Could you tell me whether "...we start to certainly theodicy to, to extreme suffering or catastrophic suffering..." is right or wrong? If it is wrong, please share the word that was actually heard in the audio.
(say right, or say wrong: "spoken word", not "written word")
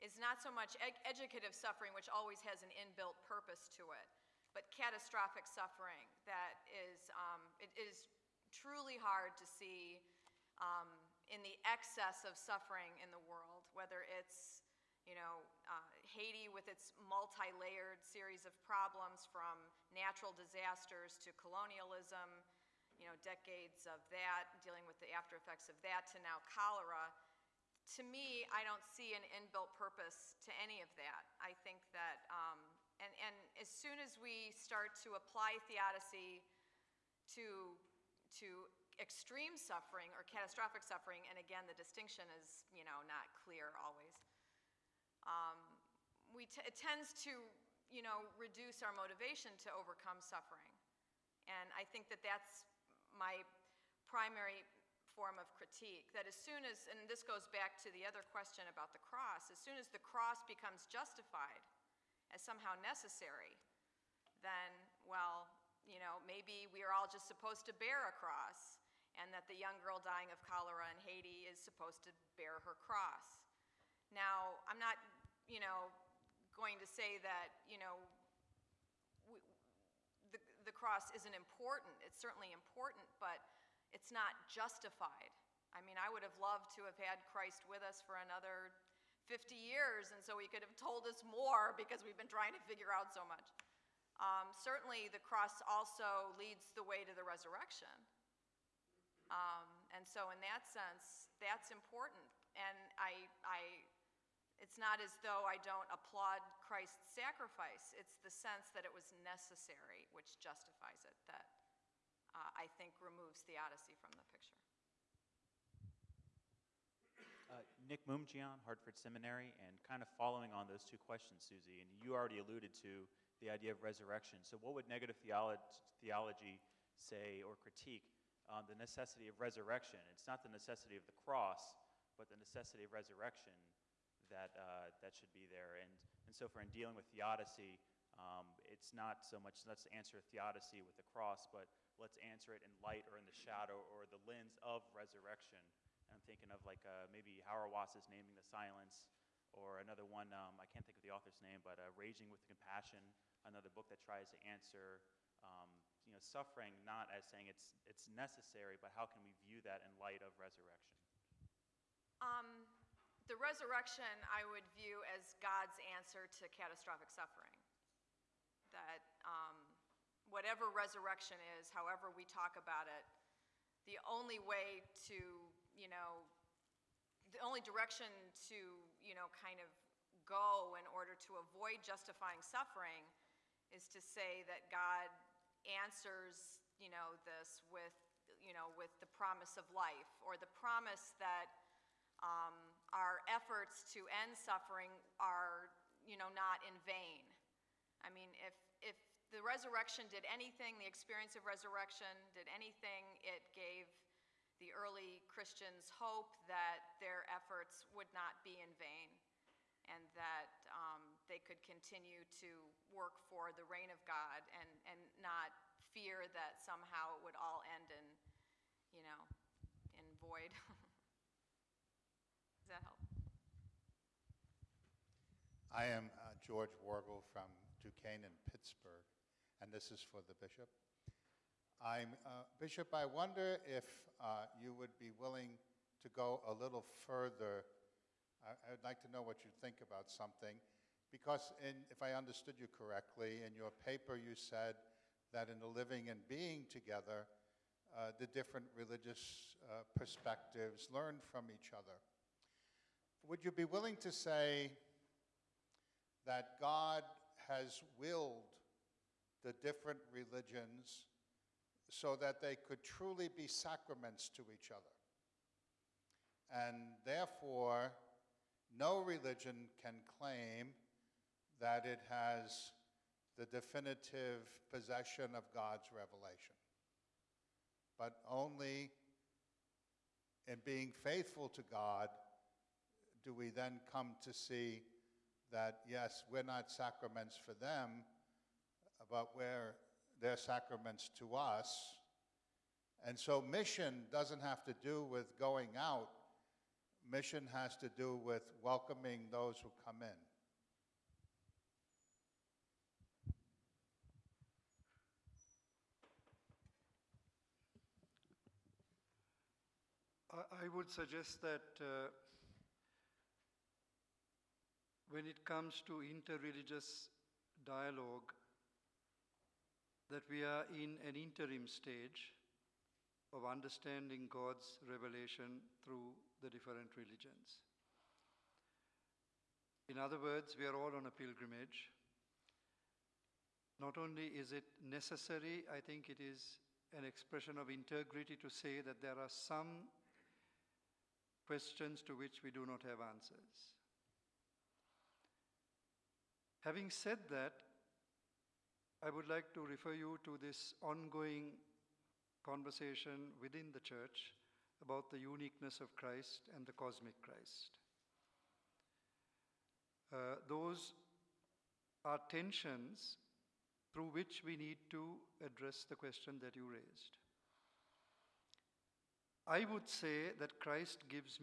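wrong: "apply", not "certainly".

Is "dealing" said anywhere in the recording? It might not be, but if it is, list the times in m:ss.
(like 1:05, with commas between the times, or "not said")
0:24, 2:16.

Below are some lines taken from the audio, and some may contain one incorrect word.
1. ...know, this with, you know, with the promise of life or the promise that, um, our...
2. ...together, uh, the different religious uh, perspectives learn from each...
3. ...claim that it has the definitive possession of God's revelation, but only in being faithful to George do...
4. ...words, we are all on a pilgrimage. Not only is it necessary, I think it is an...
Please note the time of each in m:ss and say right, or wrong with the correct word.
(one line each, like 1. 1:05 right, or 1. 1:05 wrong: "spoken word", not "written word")
1. 3:06 right
2. 4:06 right
3. 4:30 wrong: "God", not "George"
4. 5:30 right.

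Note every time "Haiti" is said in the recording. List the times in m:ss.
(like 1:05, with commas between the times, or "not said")
0:16, 1:11.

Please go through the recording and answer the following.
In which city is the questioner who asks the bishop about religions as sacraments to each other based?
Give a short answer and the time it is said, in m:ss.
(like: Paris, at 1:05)
Pittsburgh, at 3:48.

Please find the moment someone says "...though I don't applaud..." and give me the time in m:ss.
1:45.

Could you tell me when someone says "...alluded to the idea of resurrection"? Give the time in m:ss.
2:02.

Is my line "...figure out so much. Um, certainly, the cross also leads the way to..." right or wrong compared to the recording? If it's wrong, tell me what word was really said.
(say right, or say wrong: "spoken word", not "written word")
right.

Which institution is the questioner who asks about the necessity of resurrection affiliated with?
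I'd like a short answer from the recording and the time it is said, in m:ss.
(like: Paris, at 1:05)
Hartford Seminary, at 1:58.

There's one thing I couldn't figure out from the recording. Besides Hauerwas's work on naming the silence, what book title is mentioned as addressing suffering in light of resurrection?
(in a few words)
Raging with Compassion.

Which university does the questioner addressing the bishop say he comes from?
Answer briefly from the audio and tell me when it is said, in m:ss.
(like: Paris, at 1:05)
Duquesne, at 3:47.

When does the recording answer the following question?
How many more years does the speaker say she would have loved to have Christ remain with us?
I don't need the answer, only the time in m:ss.
1:28.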